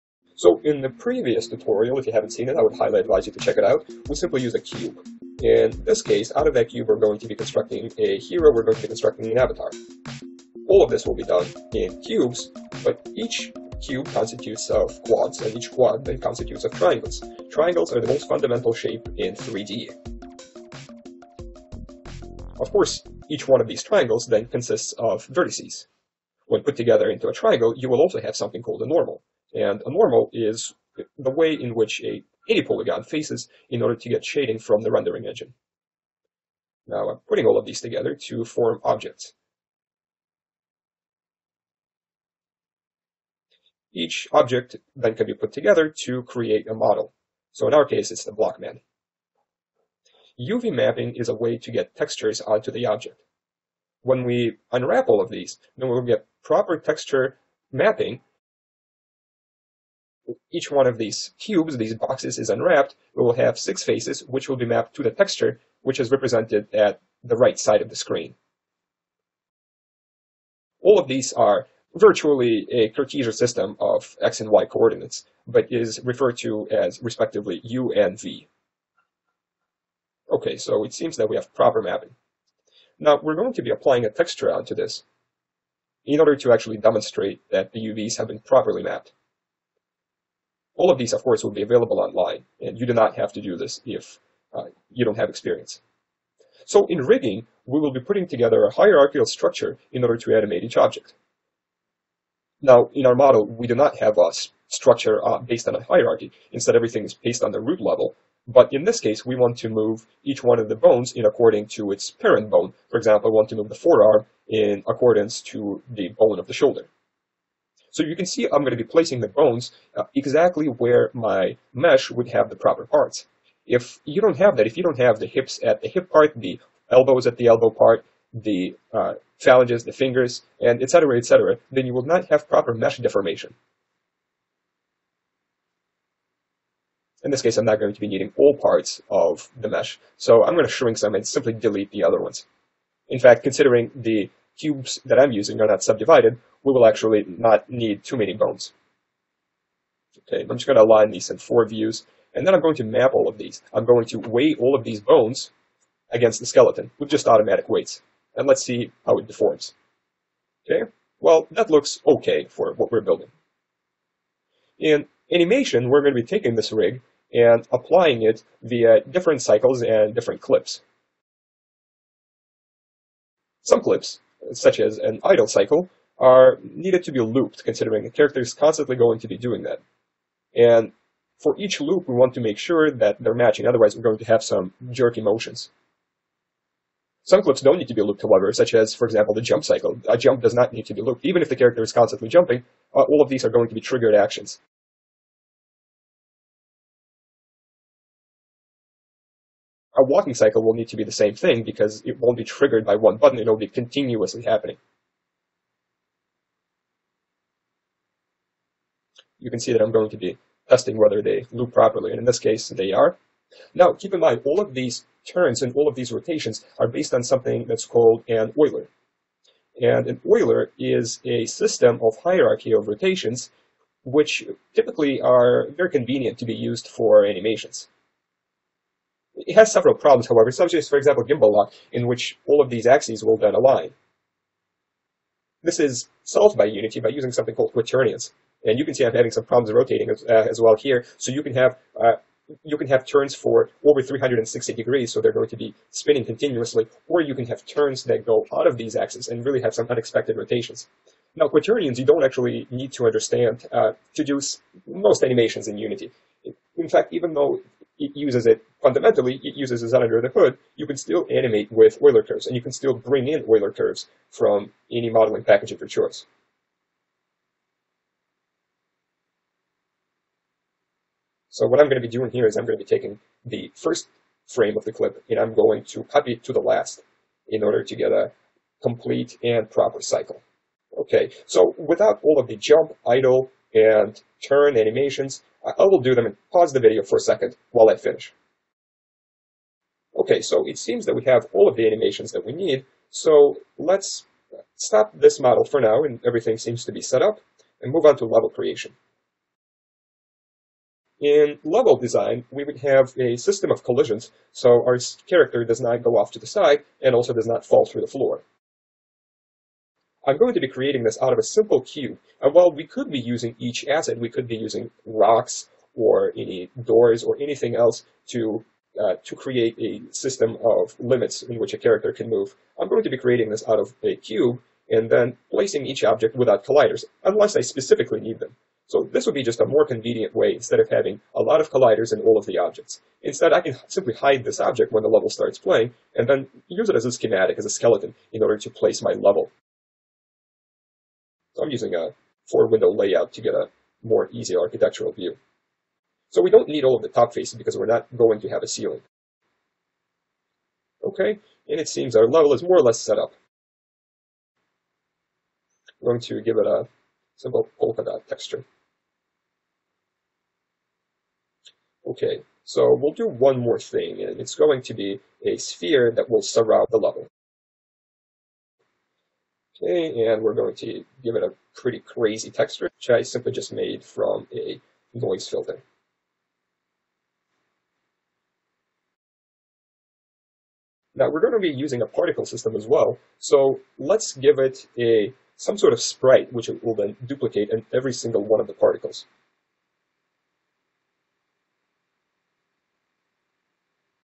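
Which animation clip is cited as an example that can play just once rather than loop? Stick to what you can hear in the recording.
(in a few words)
Jump cycle.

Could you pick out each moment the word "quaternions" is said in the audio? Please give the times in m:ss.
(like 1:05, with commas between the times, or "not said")
3:57, 4:11.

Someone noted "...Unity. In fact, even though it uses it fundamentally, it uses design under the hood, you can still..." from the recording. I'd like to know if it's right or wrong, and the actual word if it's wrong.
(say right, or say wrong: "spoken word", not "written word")
right.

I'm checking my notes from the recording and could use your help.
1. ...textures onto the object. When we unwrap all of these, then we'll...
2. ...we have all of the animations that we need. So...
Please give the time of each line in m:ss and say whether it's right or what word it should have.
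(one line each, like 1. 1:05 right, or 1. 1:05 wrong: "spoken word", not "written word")
1. 0:51 right
2. 4:51 right.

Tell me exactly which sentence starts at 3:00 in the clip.
And for each loop, we want to make sure that they're matching, otherwise we're going to have some jerky motions.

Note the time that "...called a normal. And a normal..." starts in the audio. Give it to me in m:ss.
0:28.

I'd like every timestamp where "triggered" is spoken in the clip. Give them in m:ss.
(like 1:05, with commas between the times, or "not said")
3:13, 3:22.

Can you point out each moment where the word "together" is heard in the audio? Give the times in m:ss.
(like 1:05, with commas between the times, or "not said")
0:26, 0:37, 0:45, 1:38.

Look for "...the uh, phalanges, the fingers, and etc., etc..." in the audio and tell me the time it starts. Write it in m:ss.
2:08.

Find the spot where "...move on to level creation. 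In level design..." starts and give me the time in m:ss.
4:57.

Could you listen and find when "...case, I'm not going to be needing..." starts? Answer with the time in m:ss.
2:17.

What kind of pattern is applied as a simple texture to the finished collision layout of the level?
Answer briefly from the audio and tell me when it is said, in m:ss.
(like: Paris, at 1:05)
Polka dot, at 5:57.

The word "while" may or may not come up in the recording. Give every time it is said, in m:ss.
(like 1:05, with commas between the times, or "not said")
4:47, 5:12.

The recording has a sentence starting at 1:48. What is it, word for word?
But in this case, we want to move each one of the bones in according to its parent bone.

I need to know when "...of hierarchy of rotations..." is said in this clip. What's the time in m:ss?
3:42.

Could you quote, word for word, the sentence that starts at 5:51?
Okay, and it seems our level is more or less set up.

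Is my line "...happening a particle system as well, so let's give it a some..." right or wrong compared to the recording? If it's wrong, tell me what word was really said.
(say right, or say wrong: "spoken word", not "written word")
wrong: "using", not "happening".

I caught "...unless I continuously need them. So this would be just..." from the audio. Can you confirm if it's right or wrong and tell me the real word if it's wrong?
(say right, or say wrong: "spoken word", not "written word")
wrong: "specifically", not "continuously".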